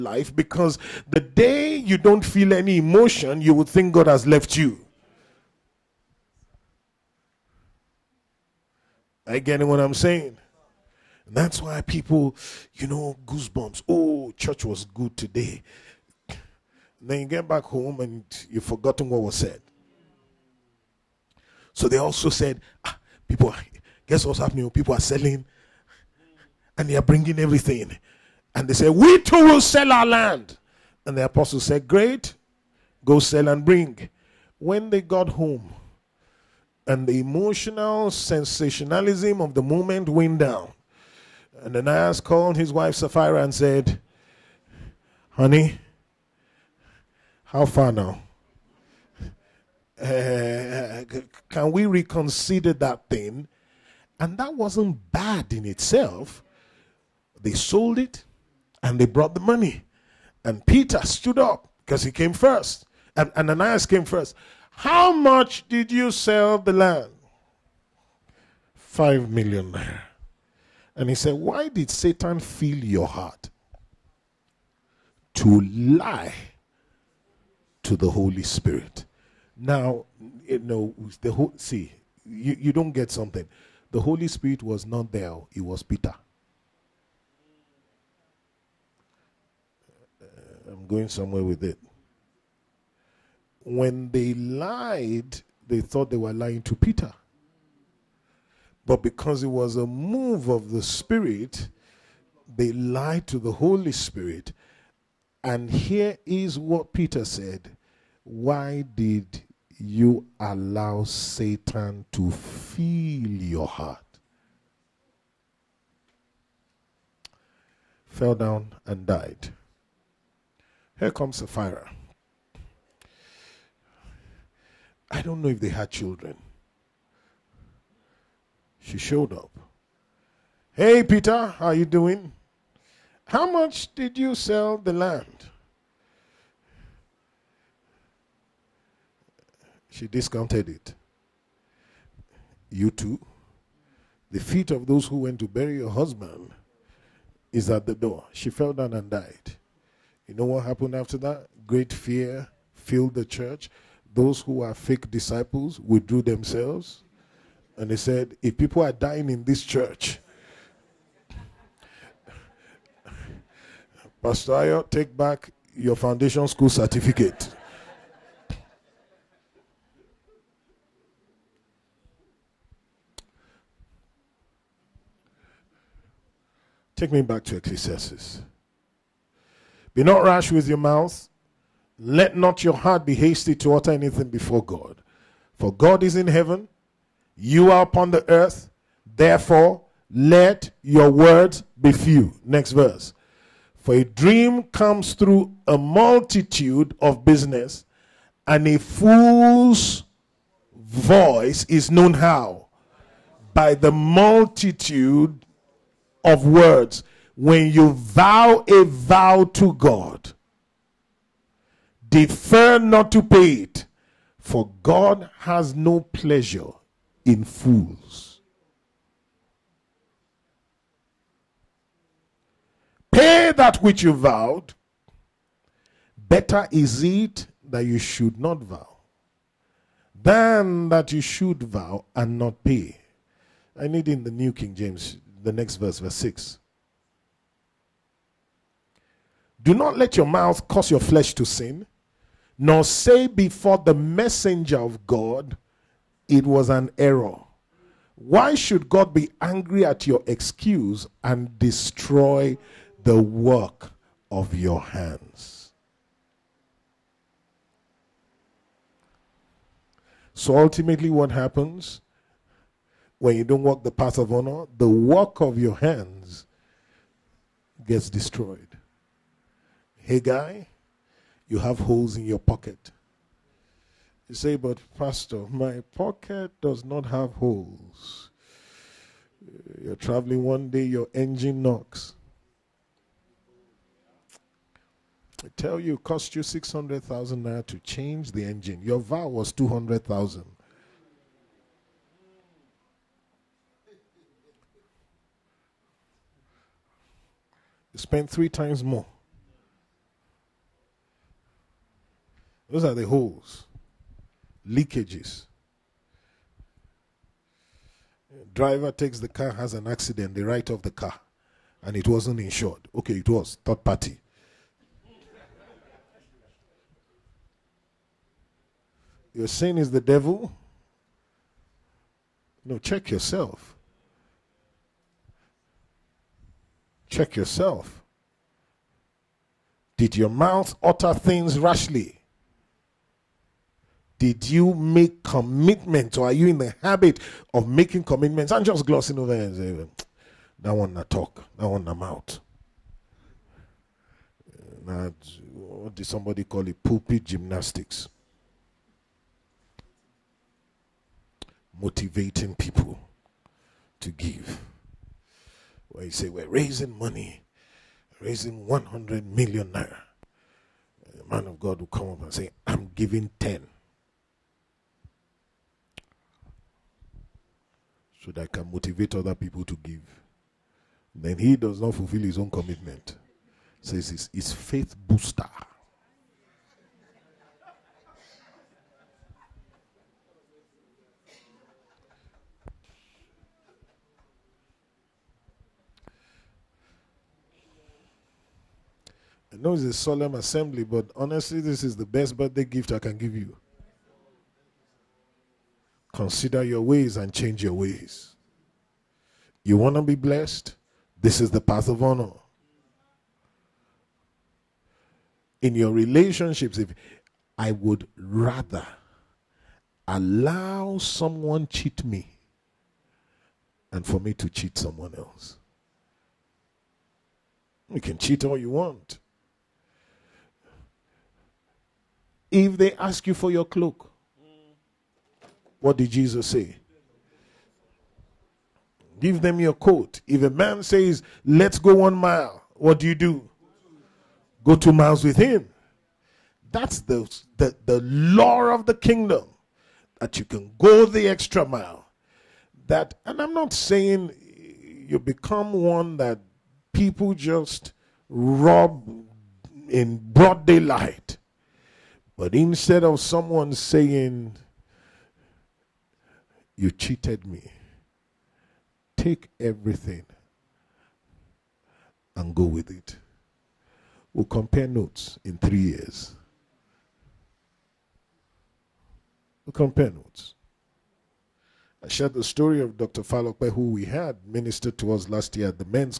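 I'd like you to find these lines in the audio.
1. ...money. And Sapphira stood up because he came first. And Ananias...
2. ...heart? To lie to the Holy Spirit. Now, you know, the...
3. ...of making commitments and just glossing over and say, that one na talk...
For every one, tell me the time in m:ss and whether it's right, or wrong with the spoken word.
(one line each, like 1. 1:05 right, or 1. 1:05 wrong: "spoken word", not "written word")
1. 0:59 wrong: "Peter", not "Sapphira"
2. 1:13 right
3. 5:37 right.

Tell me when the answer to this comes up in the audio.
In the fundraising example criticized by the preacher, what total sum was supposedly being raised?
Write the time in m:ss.
5:58.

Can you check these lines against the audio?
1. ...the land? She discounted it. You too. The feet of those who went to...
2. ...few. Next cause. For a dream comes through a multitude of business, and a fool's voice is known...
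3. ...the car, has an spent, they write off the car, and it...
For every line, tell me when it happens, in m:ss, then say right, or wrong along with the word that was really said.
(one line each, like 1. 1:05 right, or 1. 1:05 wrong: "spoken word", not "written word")
1. 2:14 right
2. 3:11 wrong: "verse", not "cause"
3. 5:09 wrong: "accident", not "spent".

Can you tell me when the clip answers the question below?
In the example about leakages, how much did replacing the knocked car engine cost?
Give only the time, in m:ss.
4:46.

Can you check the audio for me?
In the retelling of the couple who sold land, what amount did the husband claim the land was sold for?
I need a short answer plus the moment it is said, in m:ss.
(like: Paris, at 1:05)
5 million, at 1:08.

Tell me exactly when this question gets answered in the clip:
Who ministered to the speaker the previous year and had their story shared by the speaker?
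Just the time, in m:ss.
7:52.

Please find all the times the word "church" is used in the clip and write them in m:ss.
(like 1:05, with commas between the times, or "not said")
0:14, 2:33, 2:39.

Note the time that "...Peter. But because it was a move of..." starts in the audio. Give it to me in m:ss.
1:36.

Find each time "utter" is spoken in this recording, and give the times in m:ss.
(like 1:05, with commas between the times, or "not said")
3:03, 5:30.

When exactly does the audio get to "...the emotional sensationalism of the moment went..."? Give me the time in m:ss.
0:37.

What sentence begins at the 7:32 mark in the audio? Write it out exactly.
But instead of someone saying, you cheated me.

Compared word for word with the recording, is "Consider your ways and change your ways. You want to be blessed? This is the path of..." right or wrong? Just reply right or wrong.
right.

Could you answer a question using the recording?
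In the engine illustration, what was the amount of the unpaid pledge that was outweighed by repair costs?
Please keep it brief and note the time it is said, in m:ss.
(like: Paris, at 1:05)
200,000, at 4:49.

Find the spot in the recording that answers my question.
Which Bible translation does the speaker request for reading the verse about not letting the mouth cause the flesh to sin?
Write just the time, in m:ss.
3:54.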